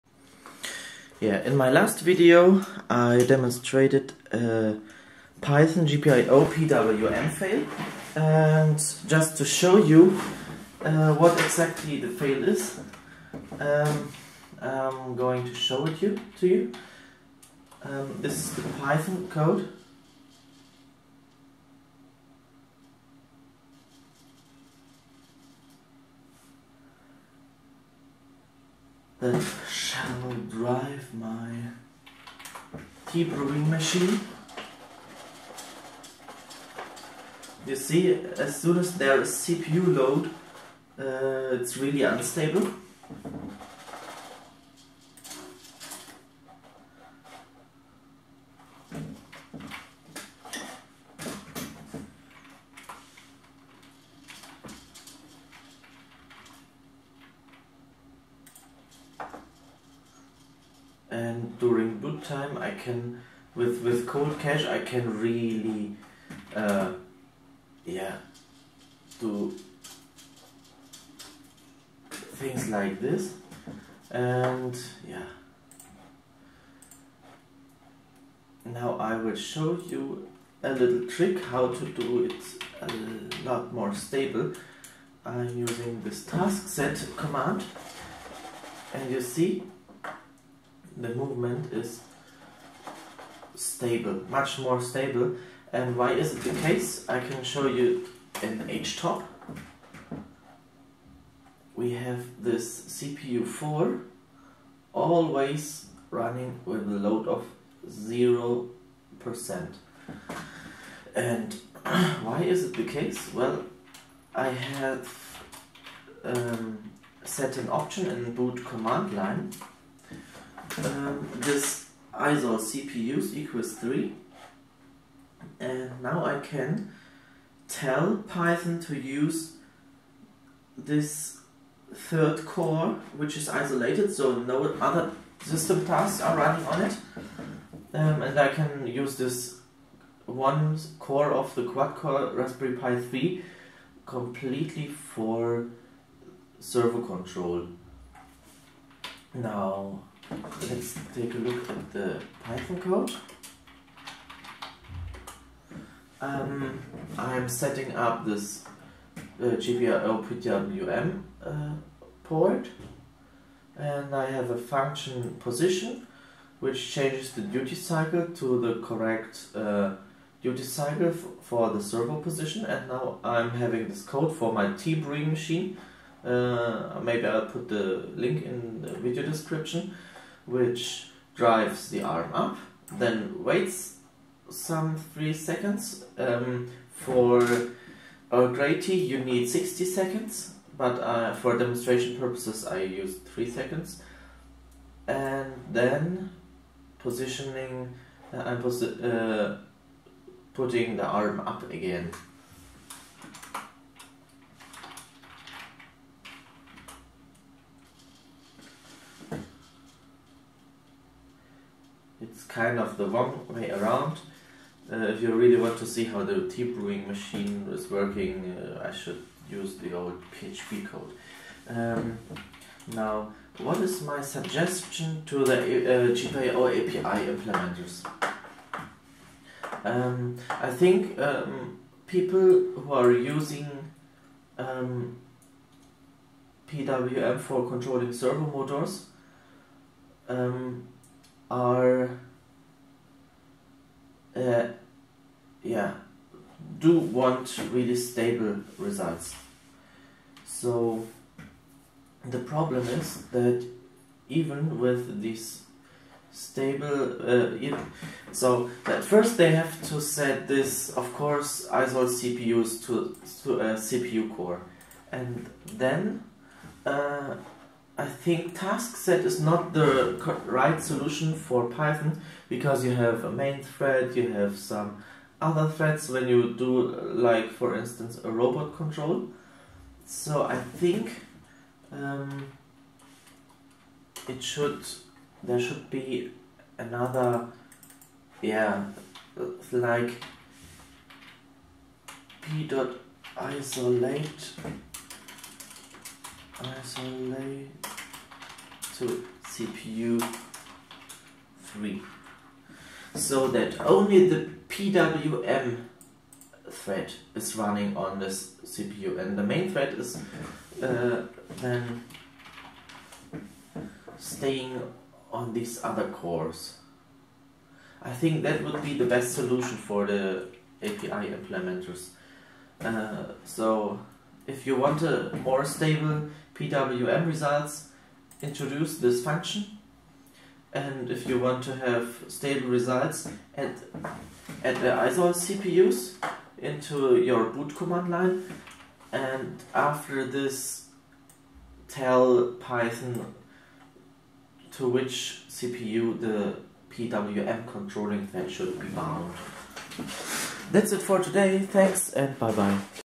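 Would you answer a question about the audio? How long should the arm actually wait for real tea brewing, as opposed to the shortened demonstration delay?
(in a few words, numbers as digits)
60 seconds.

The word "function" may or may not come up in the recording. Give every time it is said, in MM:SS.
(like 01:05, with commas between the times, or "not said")
02:44, 05:29.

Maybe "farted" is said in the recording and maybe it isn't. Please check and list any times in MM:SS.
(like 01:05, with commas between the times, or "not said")
not said.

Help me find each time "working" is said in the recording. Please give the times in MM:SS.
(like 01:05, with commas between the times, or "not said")
03:37.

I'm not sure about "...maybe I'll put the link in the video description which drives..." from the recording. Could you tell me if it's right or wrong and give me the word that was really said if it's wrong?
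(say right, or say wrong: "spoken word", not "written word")
right.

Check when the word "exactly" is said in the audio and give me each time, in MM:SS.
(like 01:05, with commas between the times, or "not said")
00:11.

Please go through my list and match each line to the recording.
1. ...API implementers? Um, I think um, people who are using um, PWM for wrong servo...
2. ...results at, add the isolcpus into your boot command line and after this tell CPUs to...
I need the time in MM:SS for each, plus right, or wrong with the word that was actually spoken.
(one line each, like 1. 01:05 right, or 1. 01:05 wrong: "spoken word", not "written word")
1. 03:46 wrong: "controlling", not "wrong"
2. 05:32 wrong: "Python", not "CPUs".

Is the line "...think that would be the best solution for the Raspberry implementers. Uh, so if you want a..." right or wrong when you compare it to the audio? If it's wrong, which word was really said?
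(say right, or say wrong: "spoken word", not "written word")
wrong: "API", not "Raspberry".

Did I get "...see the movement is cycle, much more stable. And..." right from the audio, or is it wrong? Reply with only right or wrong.
wrong.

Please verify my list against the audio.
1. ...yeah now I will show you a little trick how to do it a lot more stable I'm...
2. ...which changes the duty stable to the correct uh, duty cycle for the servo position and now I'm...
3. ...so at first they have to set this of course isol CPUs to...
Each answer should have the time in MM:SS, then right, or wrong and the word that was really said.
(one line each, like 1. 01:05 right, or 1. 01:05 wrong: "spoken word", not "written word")
1. 01:15 right
2. 02:46 wrong: "cycle", not "stable"
3. 04:18 right.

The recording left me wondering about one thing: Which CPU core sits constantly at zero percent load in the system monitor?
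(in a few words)
CPU4.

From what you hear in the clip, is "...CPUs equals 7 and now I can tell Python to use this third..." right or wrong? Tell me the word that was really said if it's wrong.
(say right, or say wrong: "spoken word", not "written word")
wrong: "3", not "7".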